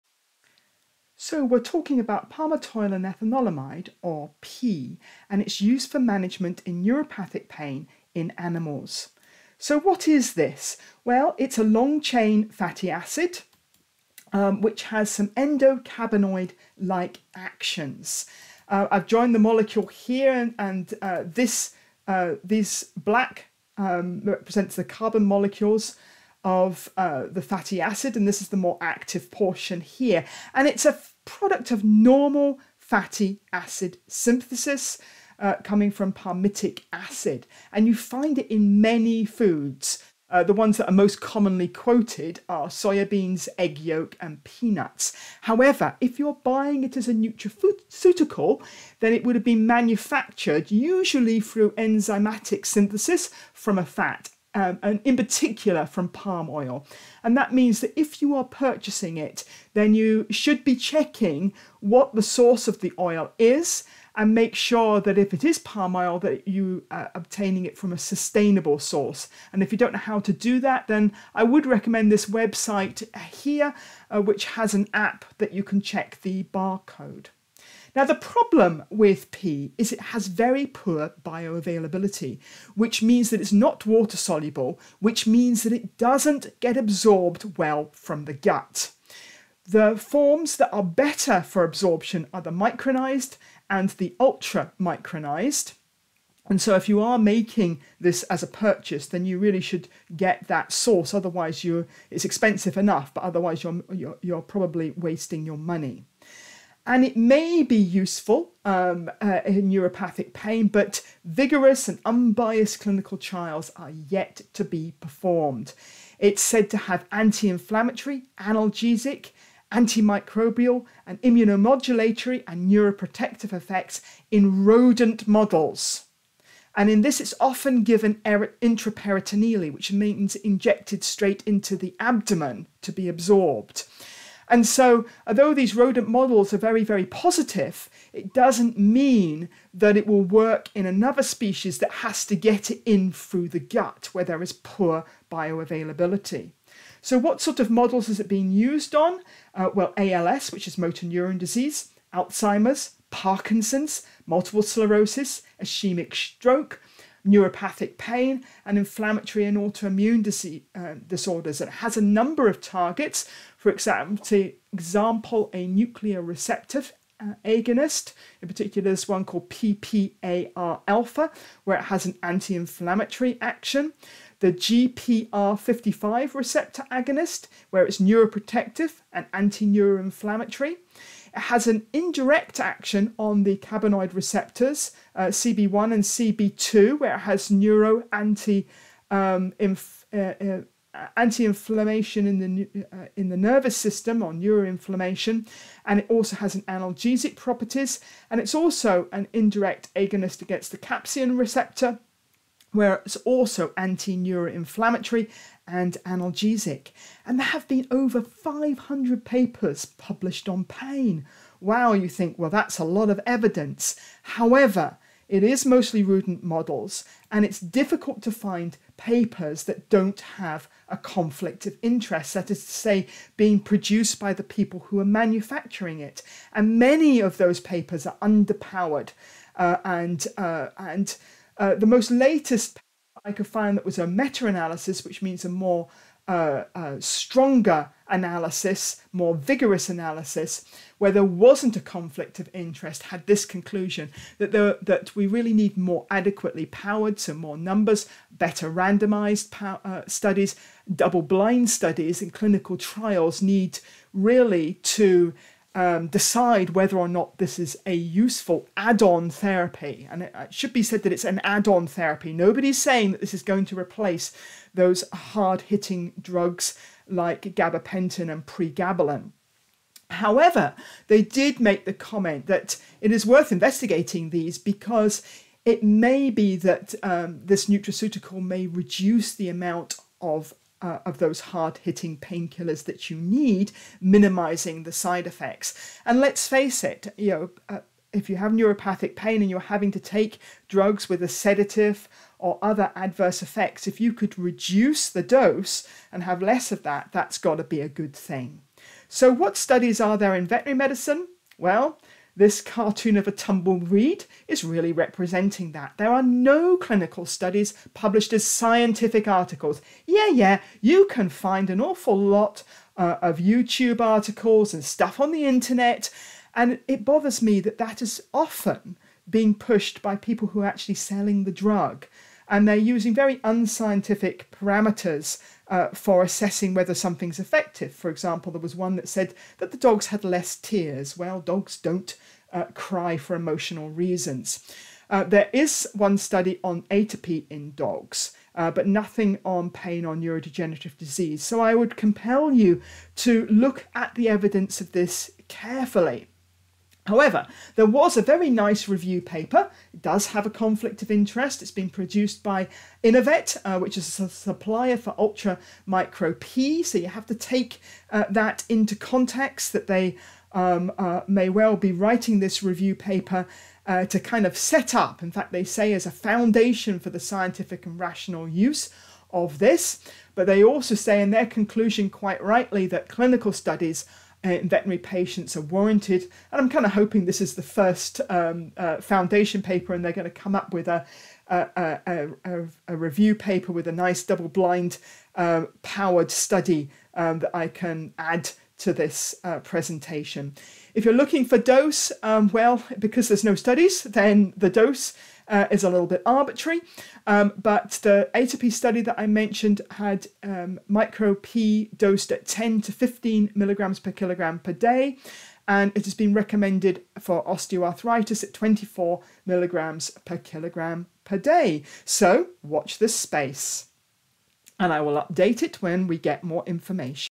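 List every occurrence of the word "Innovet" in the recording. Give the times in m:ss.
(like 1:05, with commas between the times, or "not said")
5:53.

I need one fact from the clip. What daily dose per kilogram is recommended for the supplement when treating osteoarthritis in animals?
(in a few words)
24 mg/kg per day.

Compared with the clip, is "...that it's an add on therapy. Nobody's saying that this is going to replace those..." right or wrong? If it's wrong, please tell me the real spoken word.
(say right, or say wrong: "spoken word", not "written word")
right.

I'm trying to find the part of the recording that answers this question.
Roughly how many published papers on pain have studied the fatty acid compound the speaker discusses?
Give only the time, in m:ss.
3:27.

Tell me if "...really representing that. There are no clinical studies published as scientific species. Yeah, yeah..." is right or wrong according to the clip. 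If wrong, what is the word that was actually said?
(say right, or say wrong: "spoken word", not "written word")
wrong: "articles", not "species".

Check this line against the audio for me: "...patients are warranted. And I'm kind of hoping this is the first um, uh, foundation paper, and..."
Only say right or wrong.
right.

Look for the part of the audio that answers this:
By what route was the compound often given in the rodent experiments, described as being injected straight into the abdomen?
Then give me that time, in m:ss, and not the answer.
2:08.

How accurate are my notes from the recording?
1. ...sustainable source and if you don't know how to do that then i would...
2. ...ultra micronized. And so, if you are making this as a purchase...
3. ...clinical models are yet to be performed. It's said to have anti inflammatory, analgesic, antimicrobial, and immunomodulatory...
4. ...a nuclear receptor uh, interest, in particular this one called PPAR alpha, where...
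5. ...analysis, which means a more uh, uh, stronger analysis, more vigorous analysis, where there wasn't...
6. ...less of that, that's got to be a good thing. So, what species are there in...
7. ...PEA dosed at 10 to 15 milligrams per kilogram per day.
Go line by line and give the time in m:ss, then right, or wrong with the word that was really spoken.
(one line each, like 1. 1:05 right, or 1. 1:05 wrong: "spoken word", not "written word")
1. 1:07 right
2. 1:34 right
3. 1:52 wrong: "trials", not "models"
4. 2:45 wrong: "agonist", not "interest"
5. 3:54 right
6. 4:56 wrong: "studies", not "species"
7. 6:41 right.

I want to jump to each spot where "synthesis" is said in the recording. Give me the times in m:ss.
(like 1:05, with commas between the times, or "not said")
0:34, 0:52.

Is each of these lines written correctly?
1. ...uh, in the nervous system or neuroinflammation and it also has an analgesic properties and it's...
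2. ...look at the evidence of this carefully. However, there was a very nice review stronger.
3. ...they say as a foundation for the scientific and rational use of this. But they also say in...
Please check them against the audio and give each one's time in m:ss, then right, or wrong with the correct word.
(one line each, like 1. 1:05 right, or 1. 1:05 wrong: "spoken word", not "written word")
1. 3:12 right
2. 5:43 wrong: "paper", not "stronger"
3. 6:05 right.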